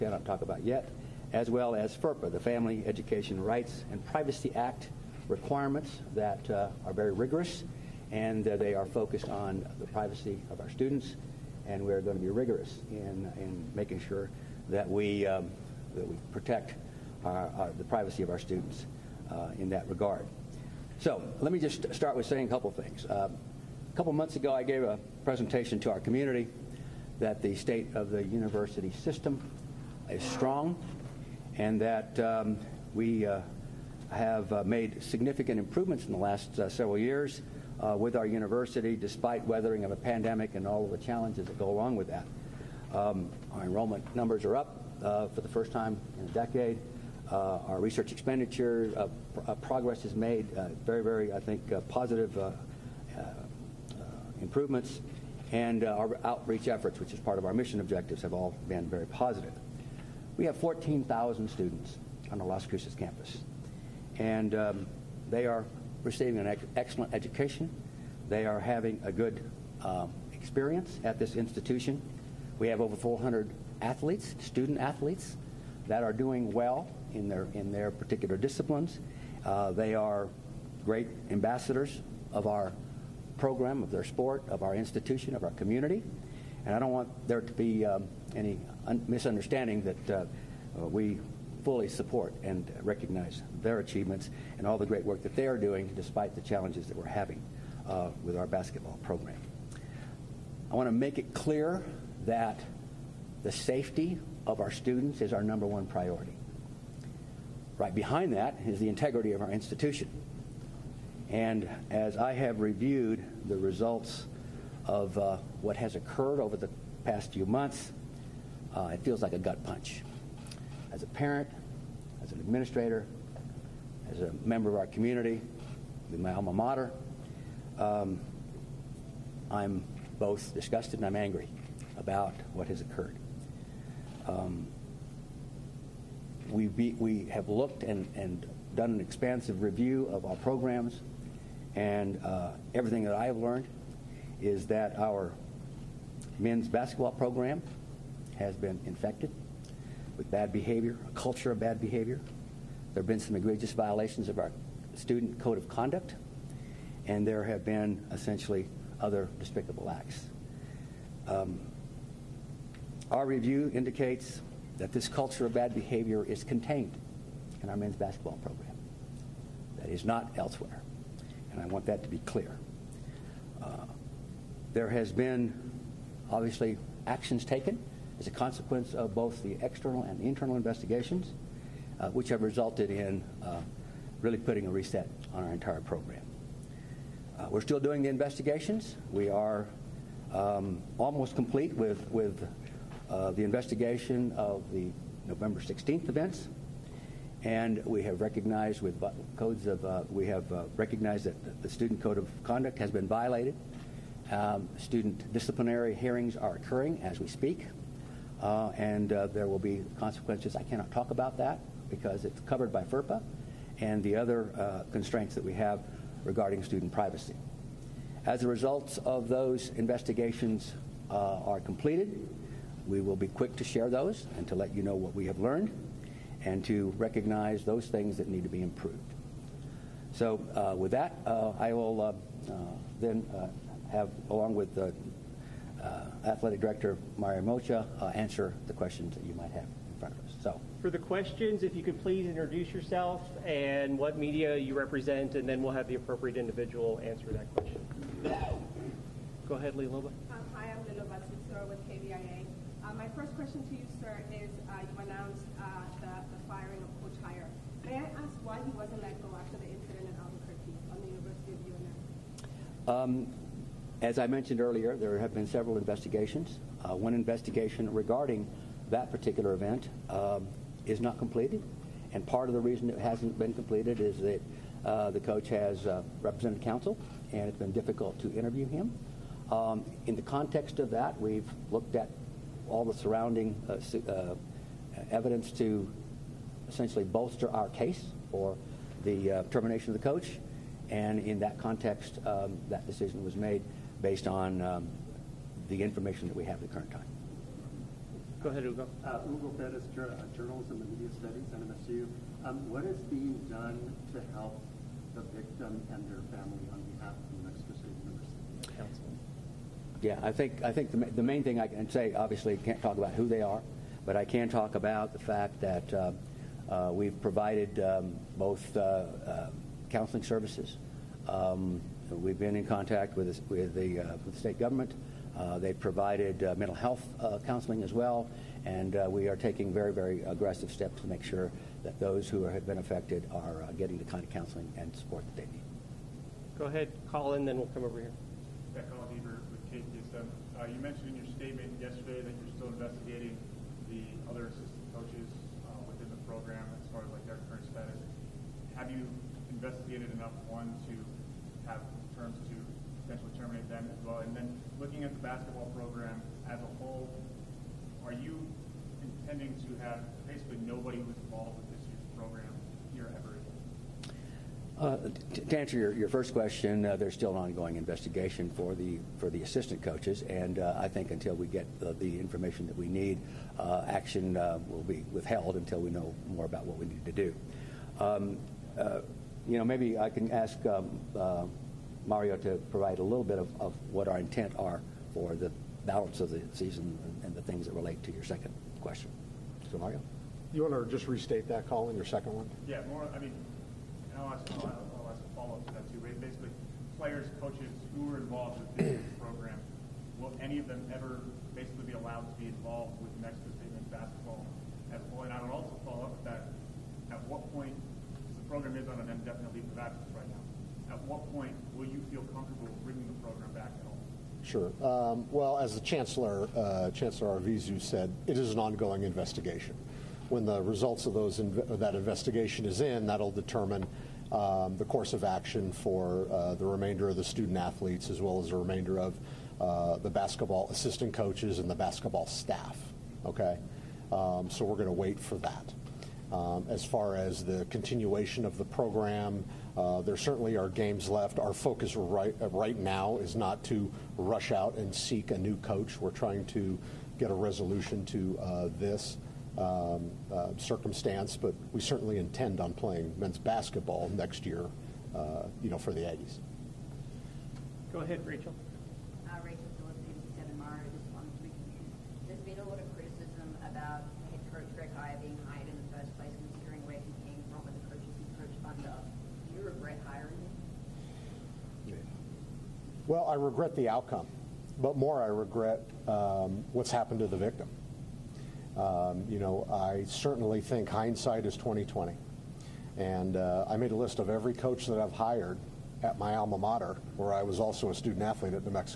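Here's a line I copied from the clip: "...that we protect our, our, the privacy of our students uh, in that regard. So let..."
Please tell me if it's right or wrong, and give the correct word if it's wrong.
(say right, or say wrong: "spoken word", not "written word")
right.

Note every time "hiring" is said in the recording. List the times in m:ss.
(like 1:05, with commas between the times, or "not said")
7:50.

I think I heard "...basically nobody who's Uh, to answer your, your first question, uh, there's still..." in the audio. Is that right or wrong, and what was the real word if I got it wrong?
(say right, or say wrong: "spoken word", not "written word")
right.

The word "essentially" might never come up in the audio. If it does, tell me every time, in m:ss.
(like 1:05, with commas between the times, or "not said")
2:38, 4:46.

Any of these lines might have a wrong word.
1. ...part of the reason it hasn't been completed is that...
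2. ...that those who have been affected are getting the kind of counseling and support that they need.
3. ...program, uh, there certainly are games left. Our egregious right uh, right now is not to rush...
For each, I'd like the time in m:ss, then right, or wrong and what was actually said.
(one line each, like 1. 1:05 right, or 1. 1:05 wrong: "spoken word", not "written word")
1. 4:32 right
2. 5:31 right
3. 7:18 wrong: "focus", not "egregious".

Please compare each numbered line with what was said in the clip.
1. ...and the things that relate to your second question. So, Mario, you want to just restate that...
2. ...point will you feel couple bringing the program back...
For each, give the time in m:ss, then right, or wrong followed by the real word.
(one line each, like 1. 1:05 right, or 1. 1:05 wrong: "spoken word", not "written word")
1. 6:27 right
2. 6:51 wrong: "comfortable", not "couple".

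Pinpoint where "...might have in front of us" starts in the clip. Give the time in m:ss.
3:59.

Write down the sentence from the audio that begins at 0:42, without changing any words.
Um, our enrollment numbers are up uh, for the first time in a decade.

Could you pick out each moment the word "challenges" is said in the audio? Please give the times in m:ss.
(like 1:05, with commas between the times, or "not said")
0:40, 1:36.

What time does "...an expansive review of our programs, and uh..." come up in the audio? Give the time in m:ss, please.
2:18.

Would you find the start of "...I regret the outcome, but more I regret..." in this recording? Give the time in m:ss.
7:53.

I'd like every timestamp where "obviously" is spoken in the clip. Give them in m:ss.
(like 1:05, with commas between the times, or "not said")
2:56, 5:12.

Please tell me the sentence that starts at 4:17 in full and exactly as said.
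May I ask why he wasn't let go after the incident in Albuquerque on the University of UNM?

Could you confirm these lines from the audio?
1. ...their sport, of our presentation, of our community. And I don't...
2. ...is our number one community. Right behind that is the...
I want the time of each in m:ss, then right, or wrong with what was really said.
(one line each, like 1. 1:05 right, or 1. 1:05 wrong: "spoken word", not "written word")
1. 1:23 wrong: "institution", not "presentation"
2. 1:45 wrong: "priority", not "community".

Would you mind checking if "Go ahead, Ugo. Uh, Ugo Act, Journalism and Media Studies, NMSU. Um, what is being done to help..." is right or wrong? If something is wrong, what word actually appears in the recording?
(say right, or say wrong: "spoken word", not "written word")
wrong: "Perez", not "Act".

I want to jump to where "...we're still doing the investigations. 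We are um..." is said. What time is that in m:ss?
3:07.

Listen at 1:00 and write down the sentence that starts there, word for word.
We have 14,000 students on the Las Cruces campus, and um, they are receiving an excellent education.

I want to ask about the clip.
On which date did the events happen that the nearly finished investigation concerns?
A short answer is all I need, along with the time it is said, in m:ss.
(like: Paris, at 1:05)
November 16, at 3:15.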